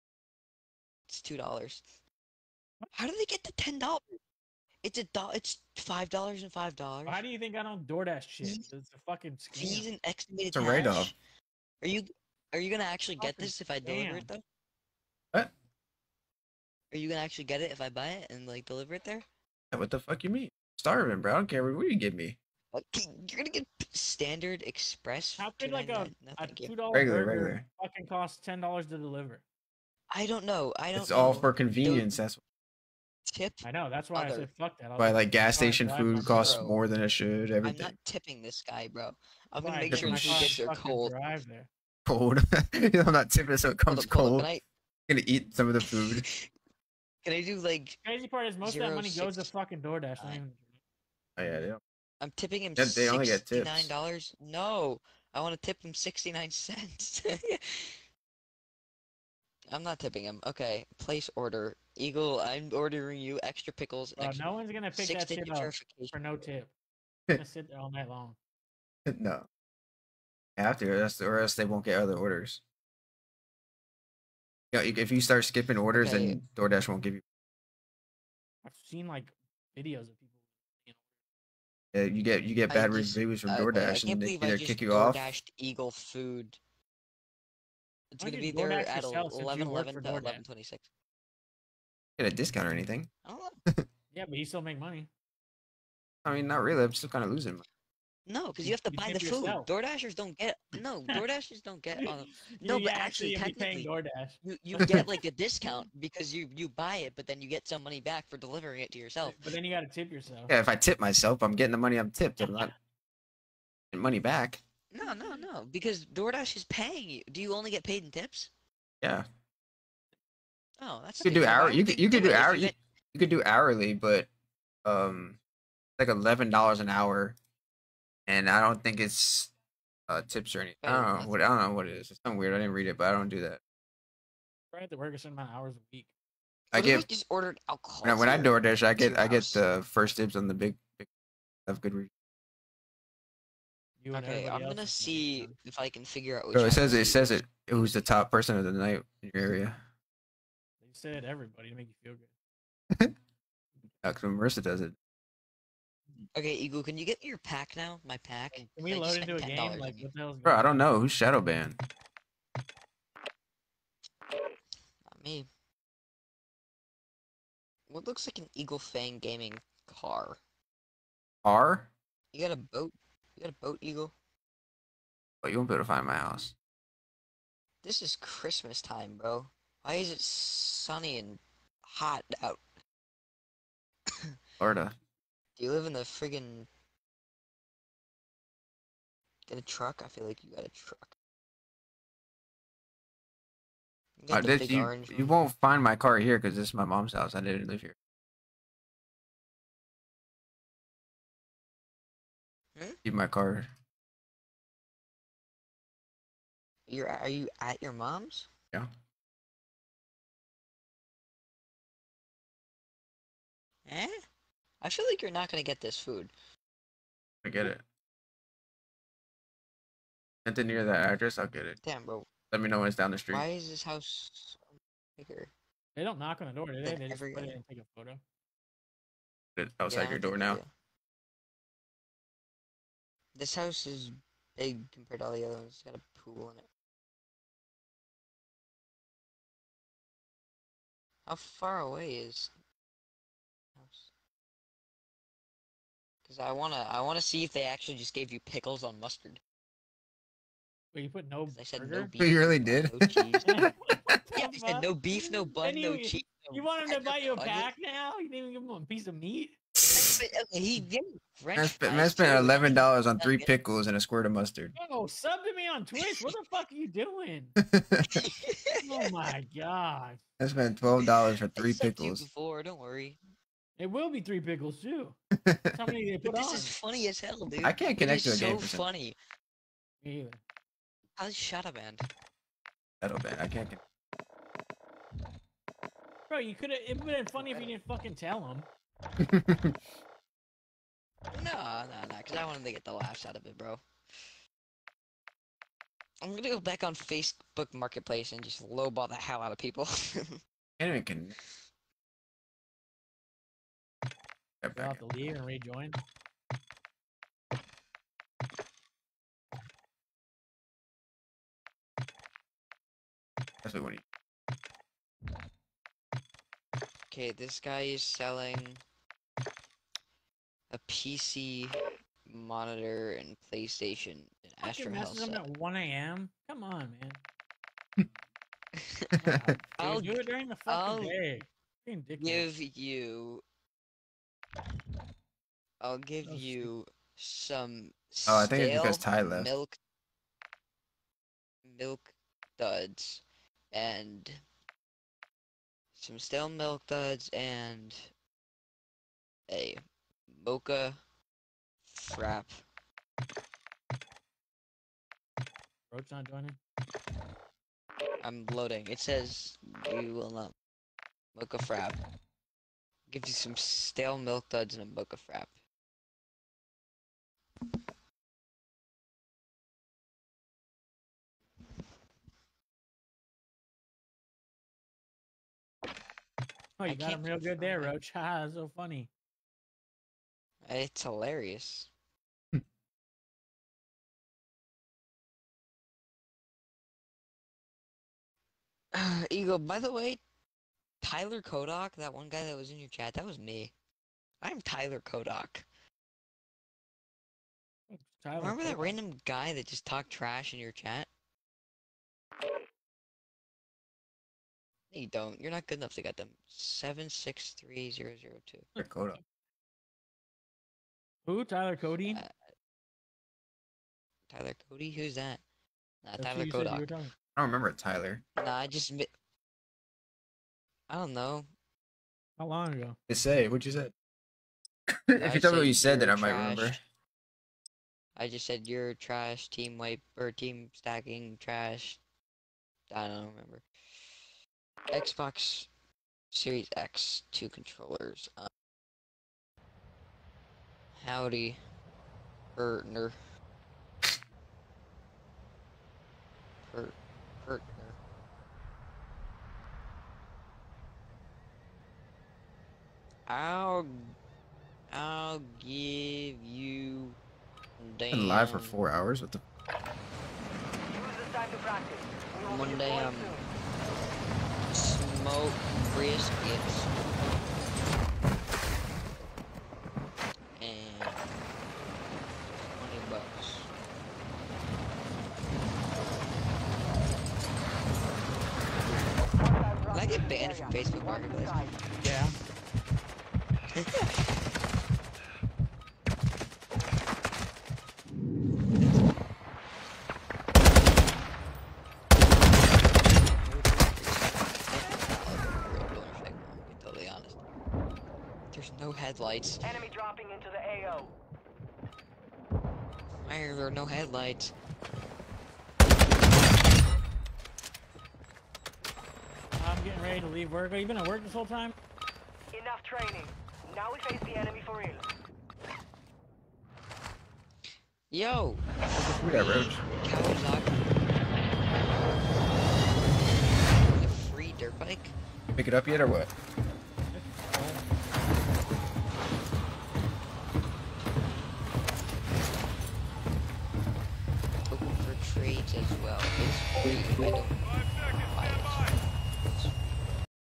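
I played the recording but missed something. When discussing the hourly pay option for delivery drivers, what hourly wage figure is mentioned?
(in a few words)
$11 an hour.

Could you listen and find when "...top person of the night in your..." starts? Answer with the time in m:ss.
2:28.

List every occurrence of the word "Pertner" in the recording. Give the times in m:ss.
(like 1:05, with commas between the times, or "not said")
7:22, 7:26.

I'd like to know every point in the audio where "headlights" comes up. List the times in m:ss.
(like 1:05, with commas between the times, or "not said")
8:18, 8:23.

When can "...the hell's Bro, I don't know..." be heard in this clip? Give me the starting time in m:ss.
2:40.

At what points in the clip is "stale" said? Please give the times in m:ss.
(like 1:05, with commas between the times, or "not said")
5:46, 6:03.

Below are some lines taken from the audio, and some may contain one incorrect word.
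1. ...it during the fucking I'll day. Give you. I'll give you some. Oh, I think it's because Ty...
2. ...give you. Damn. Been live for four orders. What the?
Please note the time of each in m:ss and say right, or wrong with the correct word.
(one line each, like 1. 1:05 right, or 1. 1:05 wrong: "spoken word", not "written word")
1. 5:30 right
2. 7:35 wrong: "hours", not "orders".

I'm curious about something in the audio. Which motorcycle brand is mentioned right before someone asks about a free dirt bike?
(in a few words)
Kawasaki.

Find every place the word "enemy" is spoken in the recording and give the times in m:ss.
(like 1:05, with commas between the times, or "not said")
8:19, 8:34.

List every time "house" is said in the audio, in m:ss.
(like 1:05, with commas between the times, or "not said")
2:56, 3:17, 3:43, 3:53, 4:03.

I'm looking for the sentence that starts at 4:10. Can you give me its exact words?
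Wait, you put no I said burger?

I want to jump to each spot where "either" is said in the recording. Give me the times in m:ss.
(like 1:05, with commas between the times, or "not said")
1:24, 4:40.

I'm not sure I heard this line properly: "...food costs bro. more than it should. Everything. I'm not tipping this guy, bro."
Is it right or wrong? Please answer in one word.
right.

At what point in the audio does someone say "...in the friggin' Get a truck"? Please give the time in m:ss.
3:05.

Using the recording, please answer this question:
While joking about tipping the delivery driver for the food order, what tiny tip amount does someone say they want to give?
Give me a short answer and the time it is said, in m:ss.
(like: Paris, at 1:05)
69 cents, at 0:55.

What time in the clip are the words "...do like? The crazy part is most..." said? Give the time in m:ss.
0:47.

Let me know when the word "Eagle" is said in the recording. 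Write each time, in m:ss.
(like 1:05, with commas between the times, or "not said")
1:01, 1:25, 2:36, 2:48, 2:53.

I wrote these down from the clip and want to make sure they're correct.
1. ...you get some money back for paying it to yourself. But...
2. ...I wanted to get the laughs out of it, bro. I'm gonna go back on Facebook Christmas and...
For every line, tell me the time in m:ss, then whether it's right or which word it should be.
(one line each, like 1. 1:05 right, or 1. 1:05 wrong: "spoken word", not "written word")
1. 1:47 wrong: "delivering", not "paying"
2. 4:52 wrong: "Marketplace", not "Christmas".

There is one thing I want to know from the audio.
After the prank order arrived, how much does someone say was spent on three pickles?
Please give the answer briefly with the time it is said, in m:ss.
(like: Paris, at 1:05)
$12, at 4:30.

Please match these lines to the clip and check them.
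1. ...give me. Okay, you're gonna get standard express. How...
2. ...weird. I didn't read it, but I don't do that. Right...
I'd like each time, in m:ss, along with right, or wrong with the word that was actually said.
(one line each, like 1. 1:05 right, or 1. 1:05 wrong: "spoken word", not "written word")
1. 0:21 right
2. 2:12 right.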